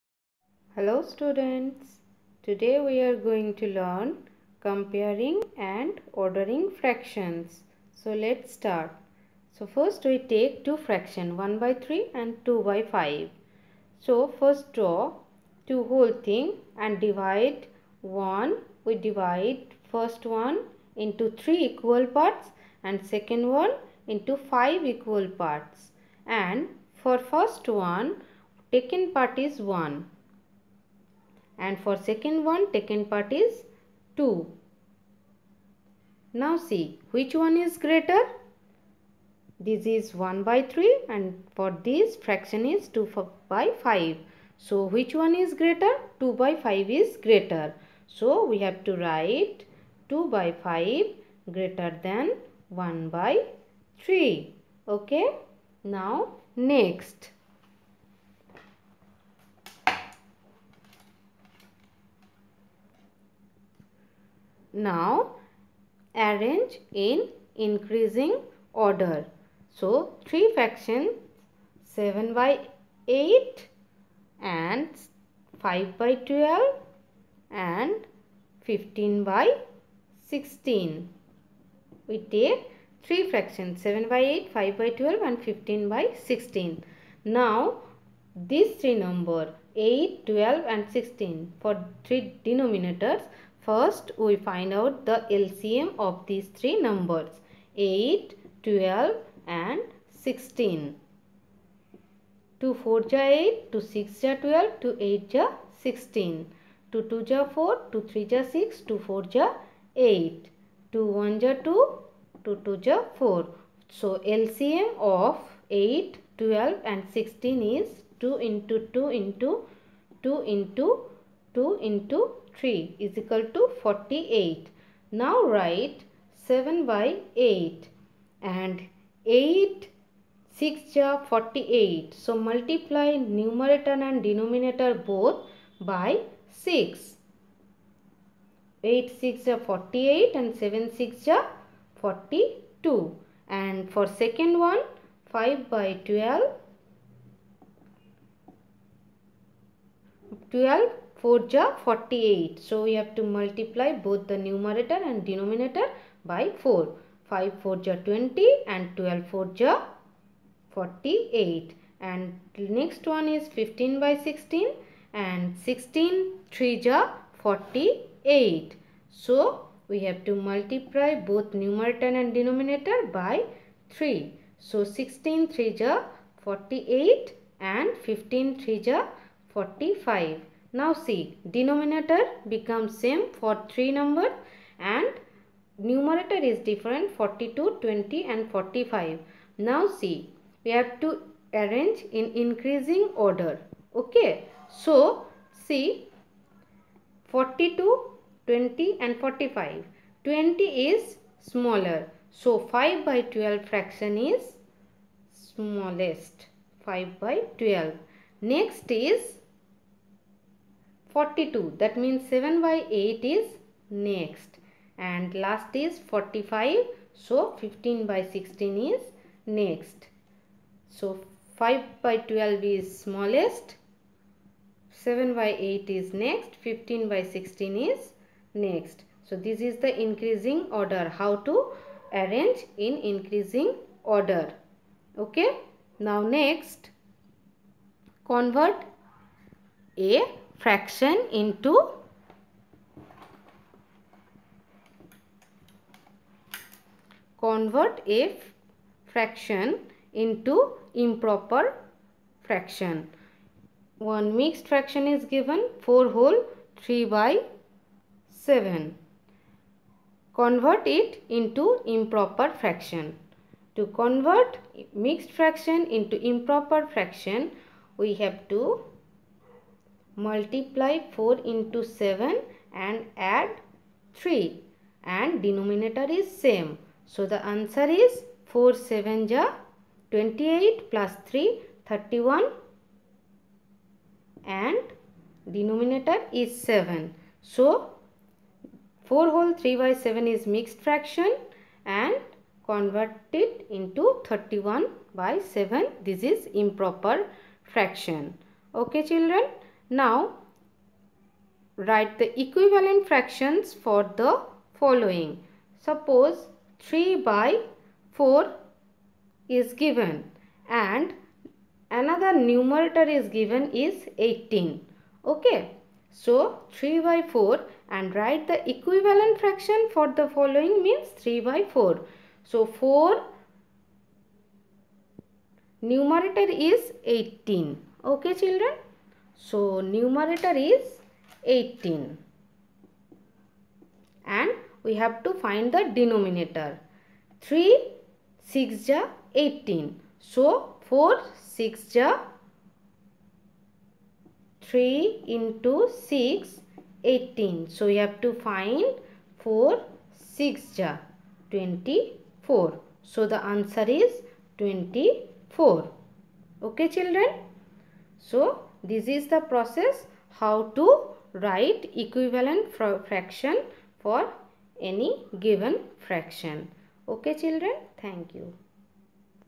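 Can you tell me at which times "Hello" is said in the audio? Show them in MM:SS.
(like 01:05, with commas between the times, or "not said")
00:00.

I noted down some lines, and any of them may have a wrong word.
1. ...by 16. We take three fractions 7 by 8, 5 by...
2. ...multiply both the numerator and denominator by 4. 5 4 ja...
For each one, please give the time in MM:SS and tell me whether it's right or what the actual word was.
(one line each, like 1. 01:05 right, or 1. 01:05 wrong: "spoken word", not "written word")
1. 01:19 right
2. 02:33 right.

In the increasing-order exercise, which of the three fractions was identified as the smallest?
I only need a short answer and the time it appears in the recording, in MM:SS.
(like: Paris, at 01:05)
5/12, at 03:22.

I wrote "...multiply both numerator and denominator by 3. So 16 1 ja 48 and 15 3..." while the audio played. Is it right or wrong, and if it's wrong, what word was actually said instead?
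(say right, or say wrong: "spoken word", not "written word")
wrong: "3", not "1".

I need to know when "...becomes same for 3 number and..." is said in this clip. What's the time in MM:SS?
03:02.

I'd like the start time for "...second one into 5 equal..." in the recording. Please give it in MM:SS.
00:23.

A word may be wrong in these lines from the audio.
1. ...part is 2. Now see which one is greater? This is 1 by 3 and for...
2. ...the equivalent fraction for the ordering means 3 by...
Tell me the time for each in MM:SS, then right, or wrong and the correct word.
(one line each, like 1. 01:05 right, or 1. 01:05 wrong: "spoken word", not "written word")
1. 00:33 right
2. 05:18 wrong: "following", not "ordering".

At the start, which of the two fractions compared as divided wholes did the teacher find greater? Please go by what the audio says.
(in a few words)
2/5.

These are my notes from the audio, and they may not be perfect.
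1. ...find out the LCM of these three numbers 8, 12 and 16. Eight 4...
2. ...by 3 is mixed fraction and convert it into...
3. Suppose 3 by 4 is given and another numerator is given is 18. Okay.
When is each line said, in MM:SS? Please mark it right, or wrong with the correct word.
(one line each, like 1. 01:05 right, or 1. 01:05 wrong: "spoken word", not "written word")
1. 01:34 wrong: "Two", not "Eight"
2. 04:49 wrong: "7", not "3"
3. 05:05 right.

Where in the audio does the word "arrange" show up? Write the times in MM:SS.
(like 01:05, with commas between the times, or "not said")
01:06, 03:11, 03:52.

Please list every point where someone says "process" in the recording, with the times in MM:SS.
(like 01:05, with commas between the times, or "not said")
05:59.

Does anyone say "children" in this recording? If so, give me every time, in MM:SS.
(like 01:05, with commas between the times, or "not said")
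04:59, 05:28, 05:56, 06:07.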